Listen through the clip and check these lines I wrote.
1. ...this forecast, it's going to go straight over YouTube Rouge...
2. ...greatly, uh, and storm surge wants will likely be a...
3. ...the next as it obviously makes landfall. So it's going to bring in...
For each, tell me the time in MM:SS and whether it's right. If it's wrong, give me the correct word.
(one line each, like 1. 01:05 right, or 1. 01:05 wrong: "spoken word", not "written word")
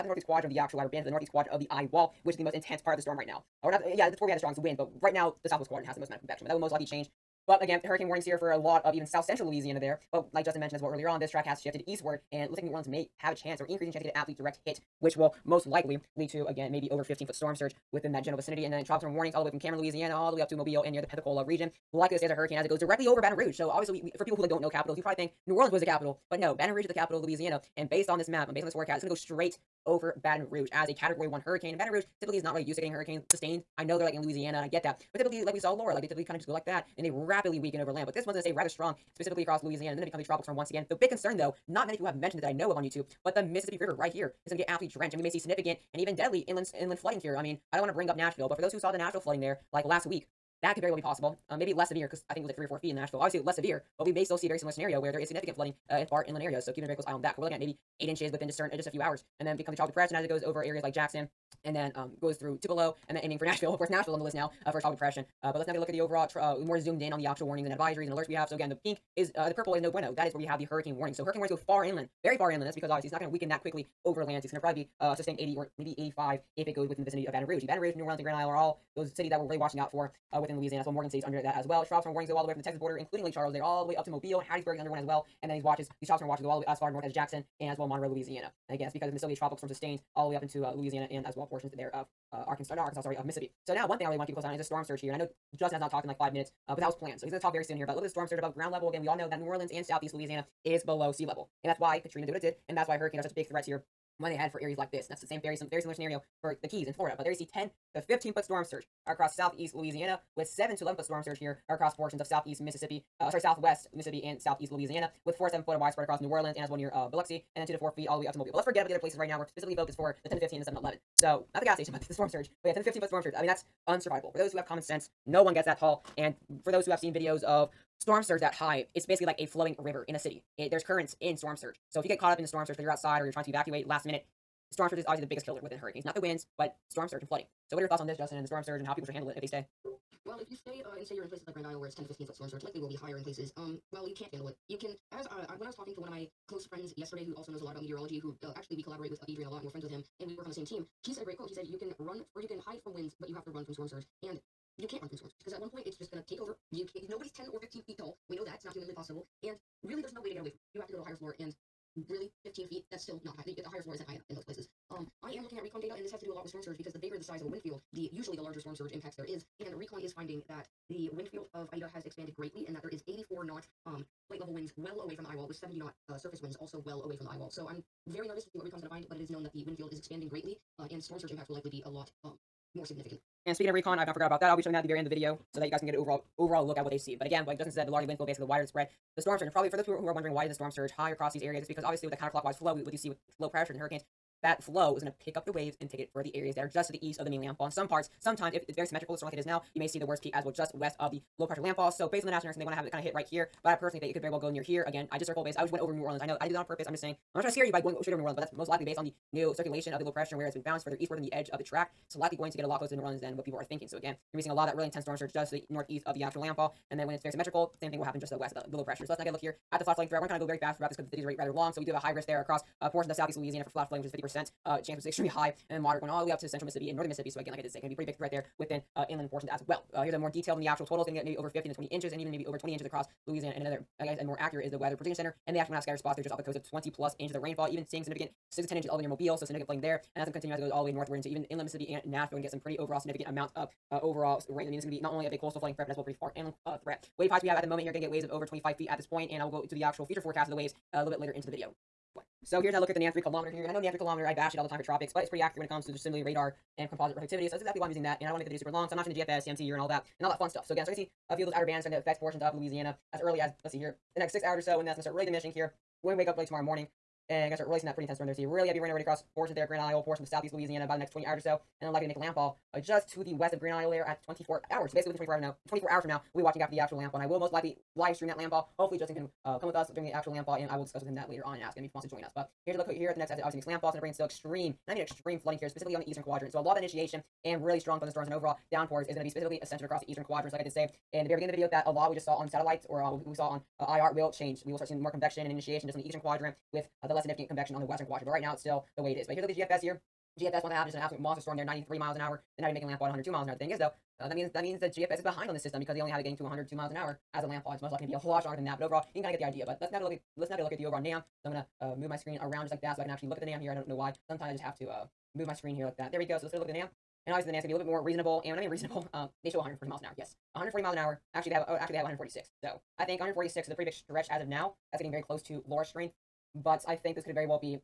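1. 00:28 wrong: "Baton", not "YouTube"
2. 03:00 wrong: "impacts", not "wants"
3. 04:43 right.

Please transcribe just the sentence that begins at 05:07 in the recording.
It's most likely to be a lot stronger than that, but overall, you can kind of get the idea.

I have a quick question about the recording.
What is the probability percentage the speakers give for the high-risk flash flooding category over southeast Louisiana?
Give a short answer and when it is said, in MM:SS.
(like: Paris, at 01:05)
50%, at 03:44.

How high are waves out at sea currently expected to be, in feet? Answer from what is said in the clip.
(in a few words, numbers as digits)
25 feet.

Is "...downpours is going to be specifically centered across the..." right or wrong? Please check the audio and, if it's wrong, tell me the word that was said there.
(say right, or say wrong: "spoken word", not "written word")
right.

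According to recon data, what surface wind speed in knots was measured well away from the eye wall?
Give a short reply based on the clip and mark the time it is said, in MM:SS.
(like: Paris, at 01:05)
70 knots, at 02:55.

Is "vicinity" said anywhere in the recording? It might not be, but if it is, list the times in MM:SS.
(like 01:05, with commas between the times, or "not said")
00:18, 01:17.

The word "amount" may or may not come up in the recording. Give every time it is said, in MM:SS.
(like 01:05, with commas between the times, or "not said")
00:06, 04:03.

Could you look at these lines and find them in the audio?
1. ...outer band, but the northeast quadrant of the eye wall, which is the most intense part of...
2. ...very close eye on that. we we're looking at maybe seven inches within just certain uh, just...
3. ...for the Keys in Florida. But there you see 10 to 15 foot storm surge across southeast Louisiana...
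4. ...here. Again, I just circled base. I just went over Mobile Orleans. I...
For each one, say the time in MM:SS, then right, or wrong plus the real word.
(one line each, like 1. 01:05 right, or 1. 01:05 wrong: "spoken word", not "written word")
1. 00:00 right
2. 00:56 wrong: "eight", not "seven"
3. 01:46 right
4. 03:24 wrong: "New", not "Mobile".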